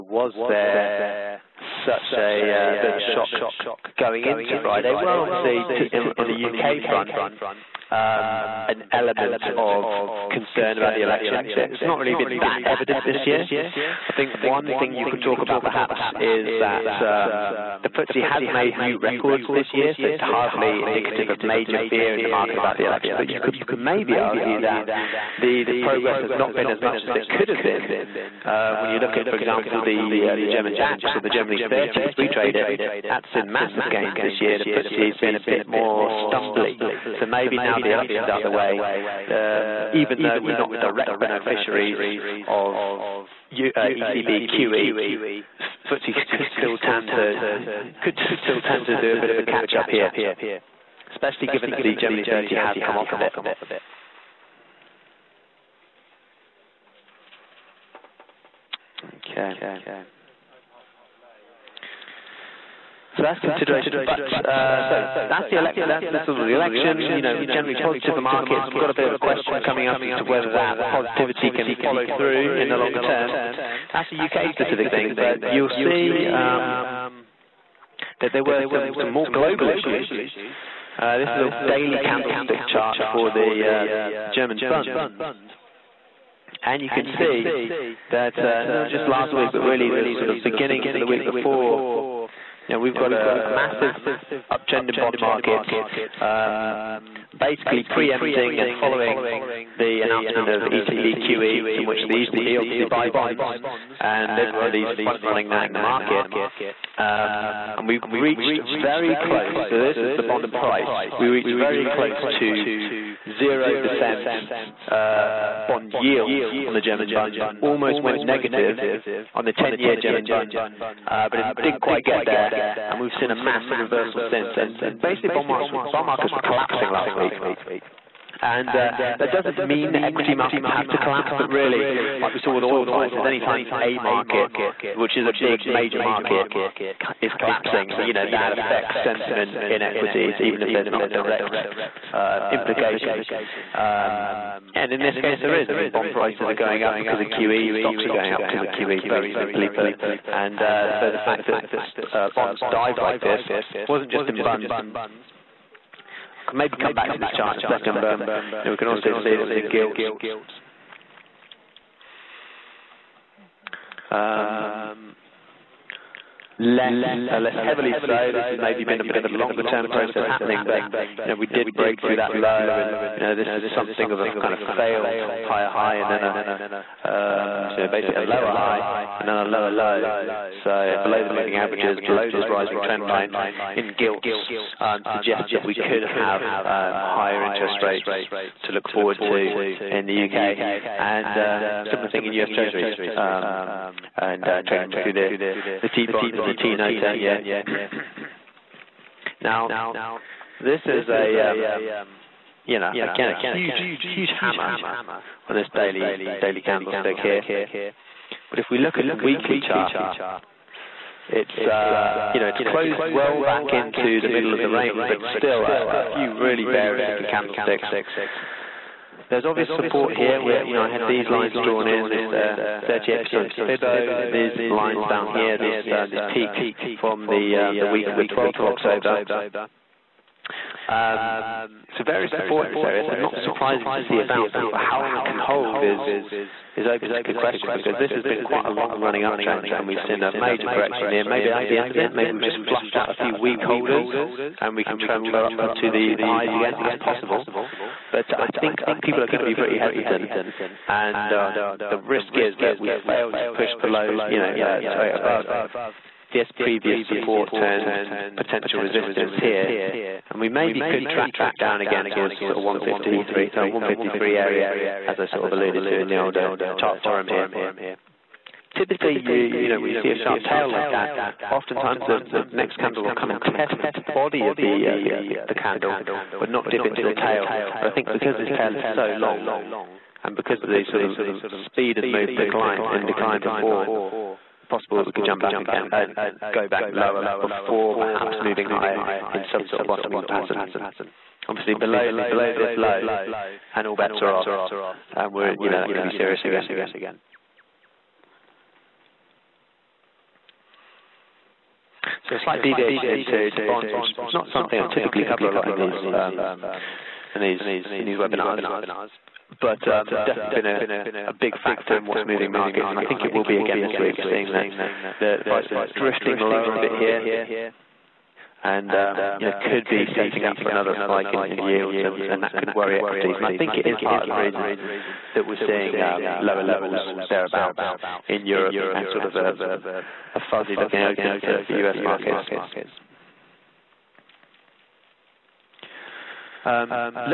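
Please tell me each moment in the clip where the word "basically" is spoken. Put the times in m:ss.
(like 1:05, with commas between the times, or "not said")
1:37, 2:04, 2:57.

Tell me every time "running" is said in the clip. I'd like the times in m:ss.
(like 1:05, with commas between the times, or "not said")
1:45, 3:58.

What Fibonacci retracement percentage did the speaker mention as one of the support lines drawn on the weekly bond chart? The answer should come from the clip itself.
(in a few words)
38%.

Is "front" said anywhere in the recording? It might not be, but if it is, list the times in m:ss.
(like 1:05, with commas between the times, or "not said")
0:06, 1:45.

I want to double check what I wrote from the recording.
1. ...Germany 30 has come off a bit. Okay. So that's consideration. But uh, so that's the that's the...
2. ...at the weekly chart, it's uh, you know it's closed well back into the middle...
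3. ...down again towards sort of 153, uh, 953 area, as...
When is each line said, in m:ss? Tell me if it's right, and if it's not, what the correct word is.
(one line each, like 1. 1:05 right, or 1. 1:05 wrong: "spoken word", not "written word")
1. 0:51 right
2. 3:28 right
3. 4:21 wrong: "153", not "953".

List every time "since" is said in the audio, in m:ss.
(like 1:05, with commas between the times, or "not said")
2:04.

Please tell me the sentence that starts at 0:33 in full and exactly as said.
That's in massive gains this year.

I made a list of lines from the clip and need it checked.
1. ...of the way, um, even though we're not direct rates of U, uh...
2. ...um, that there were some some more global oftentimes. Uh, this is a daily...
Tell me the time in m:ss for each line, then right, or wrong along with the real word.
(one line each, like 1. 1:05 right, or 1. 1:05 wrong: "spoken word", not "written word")
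1. 0:38 wrong: "beneficiaries", not "rates"
2. 1:16 wrong: "issues", not "oftentimes".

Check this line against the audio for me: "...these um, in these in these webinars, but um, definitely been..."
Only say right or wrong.
right.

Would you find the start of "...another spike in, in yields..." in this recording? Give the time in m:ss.
5:20.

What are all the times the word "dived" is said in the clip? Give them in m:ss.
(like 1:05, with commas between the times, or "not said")
2:32.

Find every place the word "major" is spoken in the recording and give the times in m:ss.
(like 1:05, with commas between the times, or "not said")
0:21, 2:15, 4:00.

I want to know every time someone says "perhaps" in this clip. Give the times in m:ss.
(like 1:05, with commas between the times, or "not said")
0:15, 4:47.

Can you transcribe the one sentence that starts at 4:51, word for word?
Obviously, below below this low, and all bets are off, and we're you know that could be serious again.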